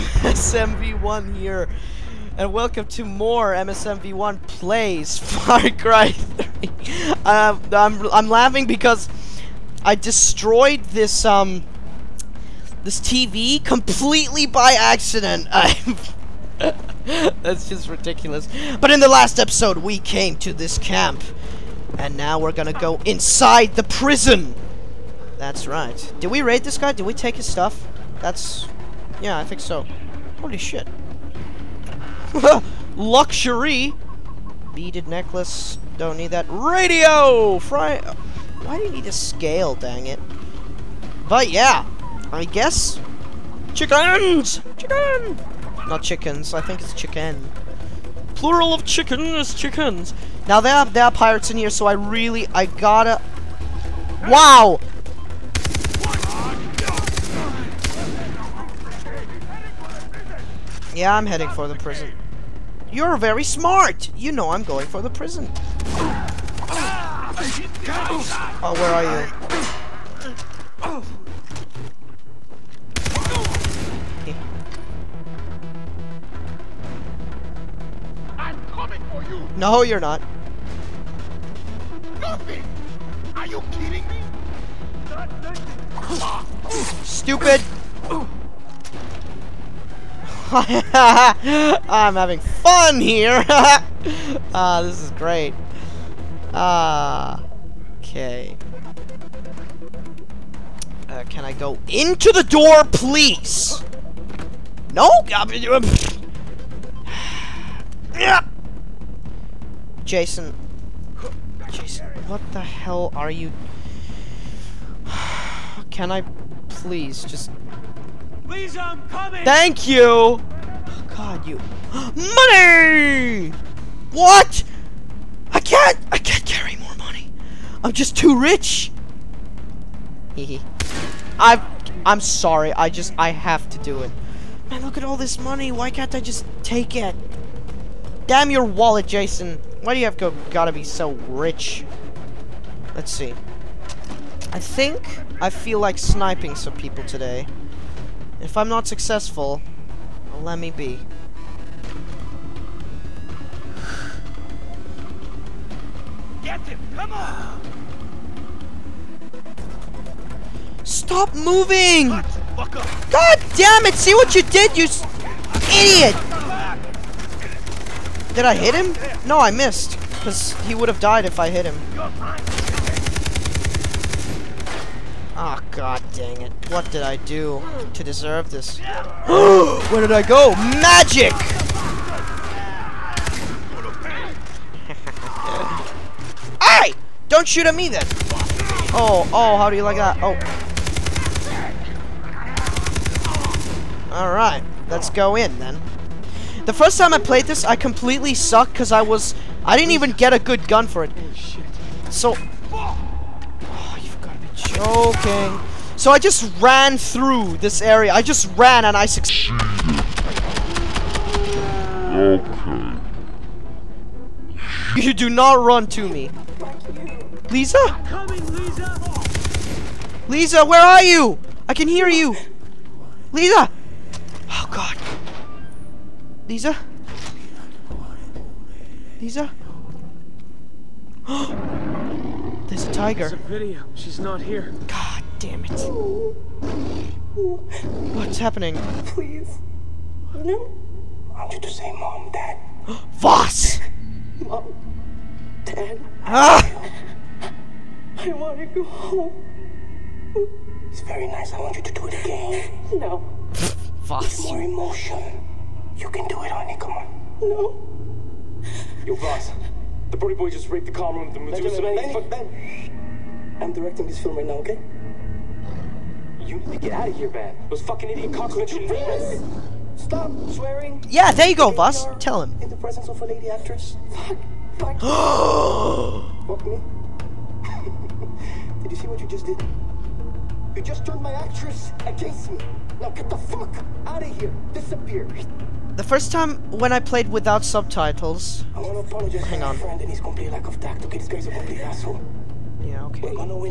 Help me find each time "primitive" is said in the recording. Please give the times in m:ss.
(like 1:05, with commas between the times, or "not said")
not said.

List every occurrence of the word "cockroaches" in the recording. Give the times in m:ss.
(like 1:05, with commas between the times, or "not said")
4:28.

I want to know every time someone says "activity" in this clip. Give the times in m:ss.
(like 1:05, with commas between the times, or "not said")
not said.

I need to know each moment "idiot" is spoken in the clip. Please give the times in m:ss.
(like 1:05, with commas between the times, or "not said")
2:45, 4:28.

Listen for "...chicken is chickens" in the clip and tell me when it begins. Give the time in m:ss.
0:48.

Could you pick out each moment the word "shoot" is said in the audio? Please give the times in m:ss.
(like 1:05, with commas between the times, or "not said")
3:07.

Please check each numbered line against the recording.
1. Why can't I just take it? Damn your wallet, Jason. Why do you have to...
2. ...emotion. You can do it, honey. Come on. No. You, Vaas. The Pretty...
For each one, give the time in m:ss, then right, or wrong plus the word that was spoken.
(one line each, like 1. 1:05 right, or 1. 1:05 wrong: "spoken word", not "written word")
1. 2:15 right
2. 4:14 right.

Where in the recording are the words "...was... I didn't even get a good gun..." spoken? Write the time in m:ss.
3:19.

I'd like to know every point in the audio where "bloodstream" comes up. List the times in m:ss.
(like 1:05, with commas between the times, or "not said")
not said.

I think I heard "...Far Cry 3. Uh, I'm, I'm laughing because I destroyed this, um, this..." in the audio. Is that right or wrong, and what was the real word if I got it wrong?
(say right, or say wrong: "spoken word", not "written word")
right.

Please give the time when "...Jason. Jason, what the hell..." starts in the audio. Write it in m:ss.
1:50.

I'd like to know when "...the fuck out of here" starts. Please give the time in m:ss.
4:43.